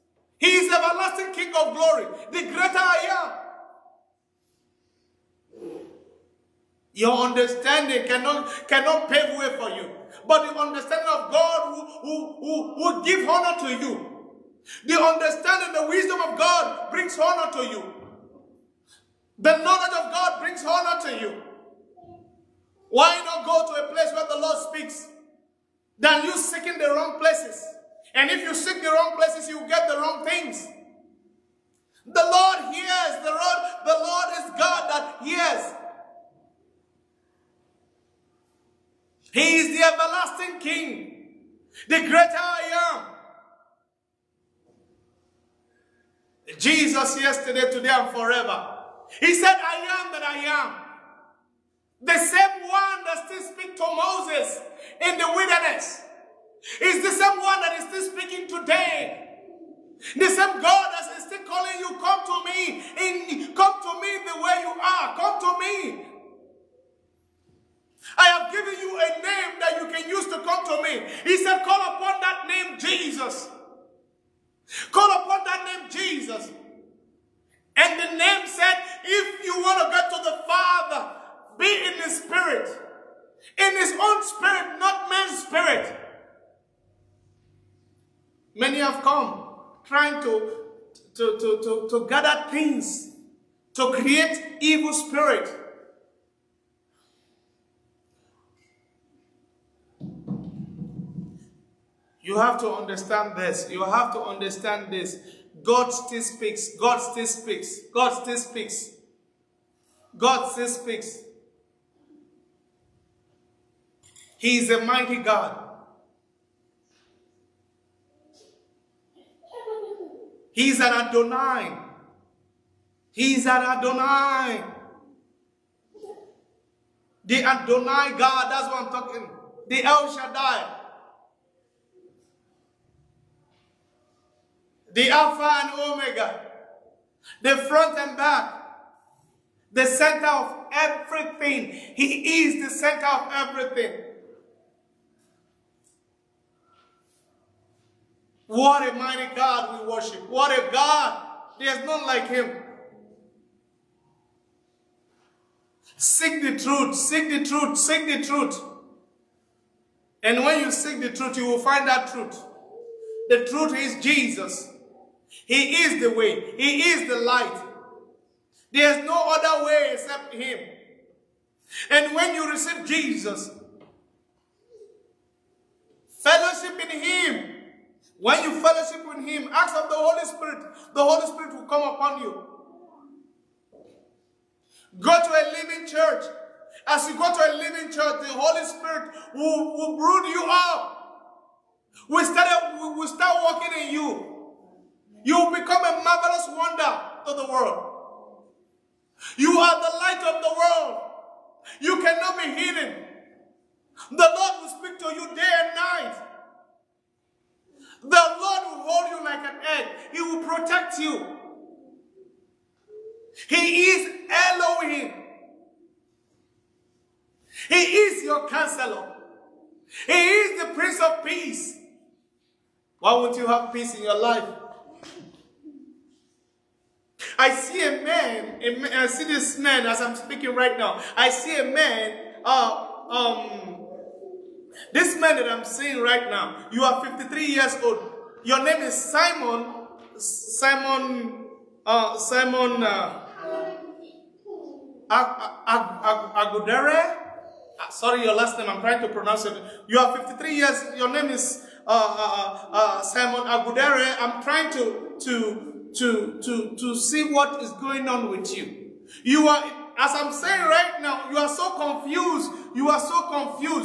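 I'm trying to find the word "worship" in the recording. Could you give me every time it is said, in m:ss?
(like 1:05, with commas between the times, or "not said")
2:29.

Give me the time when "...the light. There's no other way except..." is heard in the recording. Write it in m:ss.
2:47.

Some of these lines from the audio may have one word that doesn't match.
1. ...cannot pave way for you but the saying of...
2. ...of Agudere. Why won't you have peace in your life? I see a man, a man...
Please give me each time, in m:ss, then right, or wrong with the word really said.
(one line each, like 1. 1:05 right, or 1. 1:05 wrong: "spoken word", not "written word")
1. 0:08 wrong: "understanding", not "saying"
2. 3:41 wrong: "Peace", not "Agudere".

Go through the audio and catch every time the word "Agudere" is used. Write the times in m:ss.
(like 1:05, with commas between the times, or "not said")
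4:05, 4:13.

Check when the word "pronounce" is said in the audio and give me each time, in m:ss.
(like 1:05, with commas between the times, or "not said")
4:09.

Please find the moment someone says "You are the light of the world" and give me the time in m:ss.
3:19.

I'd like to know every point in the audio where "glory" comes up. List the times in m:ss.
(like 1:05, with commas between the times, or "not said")
0:01.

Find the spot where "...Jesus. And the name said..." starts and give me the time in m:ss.
1:15.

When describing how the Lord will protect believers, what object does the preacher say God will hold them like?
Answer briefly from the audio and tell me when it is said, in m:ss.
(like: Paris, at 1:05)
An egg, at 3:29.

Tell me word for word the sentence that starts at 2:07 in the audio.
The Adonai God, that's what I'm talking.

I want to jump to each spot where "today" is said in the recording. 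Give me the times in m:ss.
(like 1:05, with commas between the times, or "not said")
0:47, 0:58.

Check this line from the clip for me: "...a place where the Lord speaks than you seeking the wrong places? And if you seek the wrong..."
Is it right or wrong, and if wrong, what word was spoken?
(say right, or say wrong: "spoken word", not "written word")
right.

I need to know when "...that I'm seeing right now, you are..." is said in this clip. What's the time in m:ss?
3:55.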